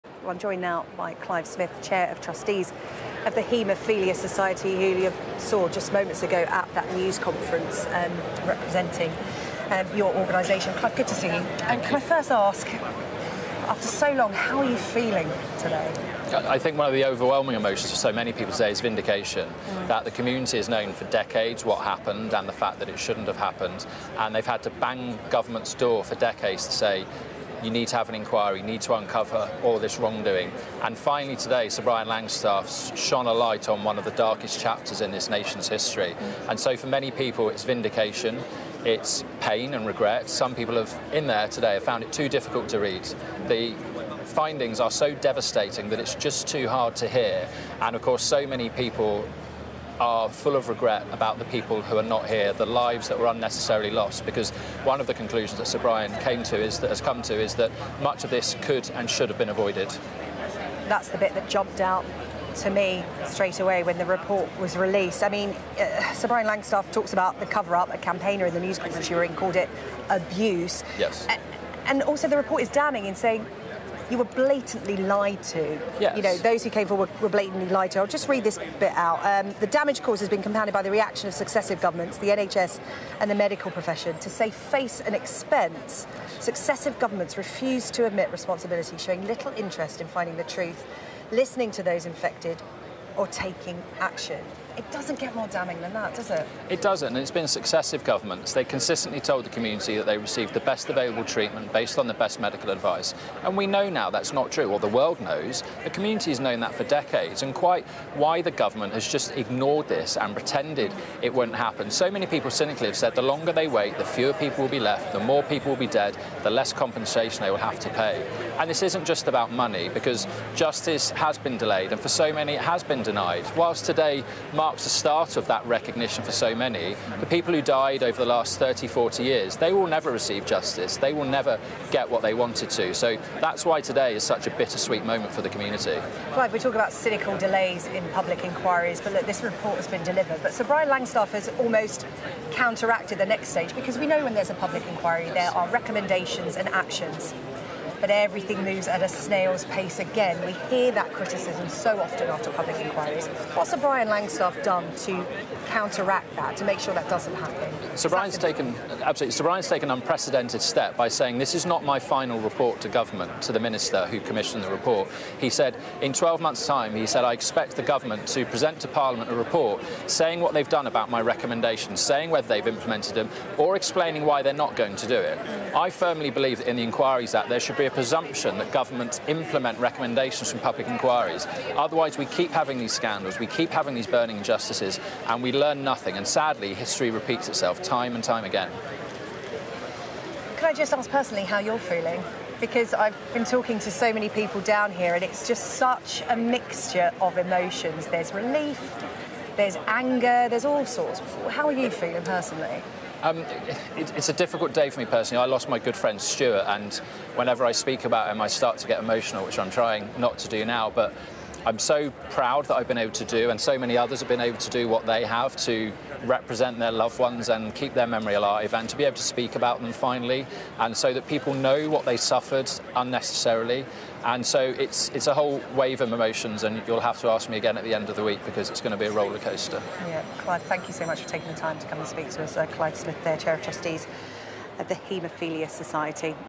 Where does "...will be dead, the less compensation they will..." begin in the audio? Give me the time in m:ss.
1:55.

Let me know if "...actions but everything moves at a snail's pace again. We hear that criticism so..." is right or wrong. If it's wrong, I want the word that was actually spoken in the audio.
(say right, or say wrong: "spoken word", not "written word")
right.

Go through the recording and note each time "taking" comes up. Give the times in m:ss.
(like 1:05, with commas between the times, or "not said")
1:33, 3:51.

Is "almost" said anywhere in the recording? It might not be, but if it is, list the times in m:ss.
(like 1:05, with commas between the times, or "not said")
2:21.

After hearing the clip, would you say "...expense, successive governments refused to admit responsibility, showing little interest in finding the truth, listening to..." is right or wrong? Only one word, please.
right.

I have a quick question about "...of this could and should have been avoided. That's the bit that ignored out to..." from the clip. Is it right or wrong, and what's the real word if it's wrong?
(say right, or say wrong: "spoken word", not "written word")
wrong: "jumped", not "ignored".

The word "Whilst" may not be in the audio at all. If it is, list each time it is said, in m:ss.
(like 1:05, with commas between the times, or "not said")
2:03.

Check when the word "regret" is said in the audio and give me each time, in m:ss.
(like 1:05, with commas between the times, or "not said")
0:39, 0:50.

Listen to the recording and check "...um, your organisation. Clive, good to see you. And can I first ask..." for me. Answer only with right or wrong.
right.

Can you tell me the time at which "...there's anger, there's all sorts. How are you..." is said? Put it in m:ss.
3:19.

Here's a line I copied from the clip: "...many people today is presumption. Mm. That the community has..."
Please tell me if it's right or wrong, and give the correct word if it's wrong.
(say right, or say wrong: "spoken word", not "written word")
wrong: "vindication", not "presumption".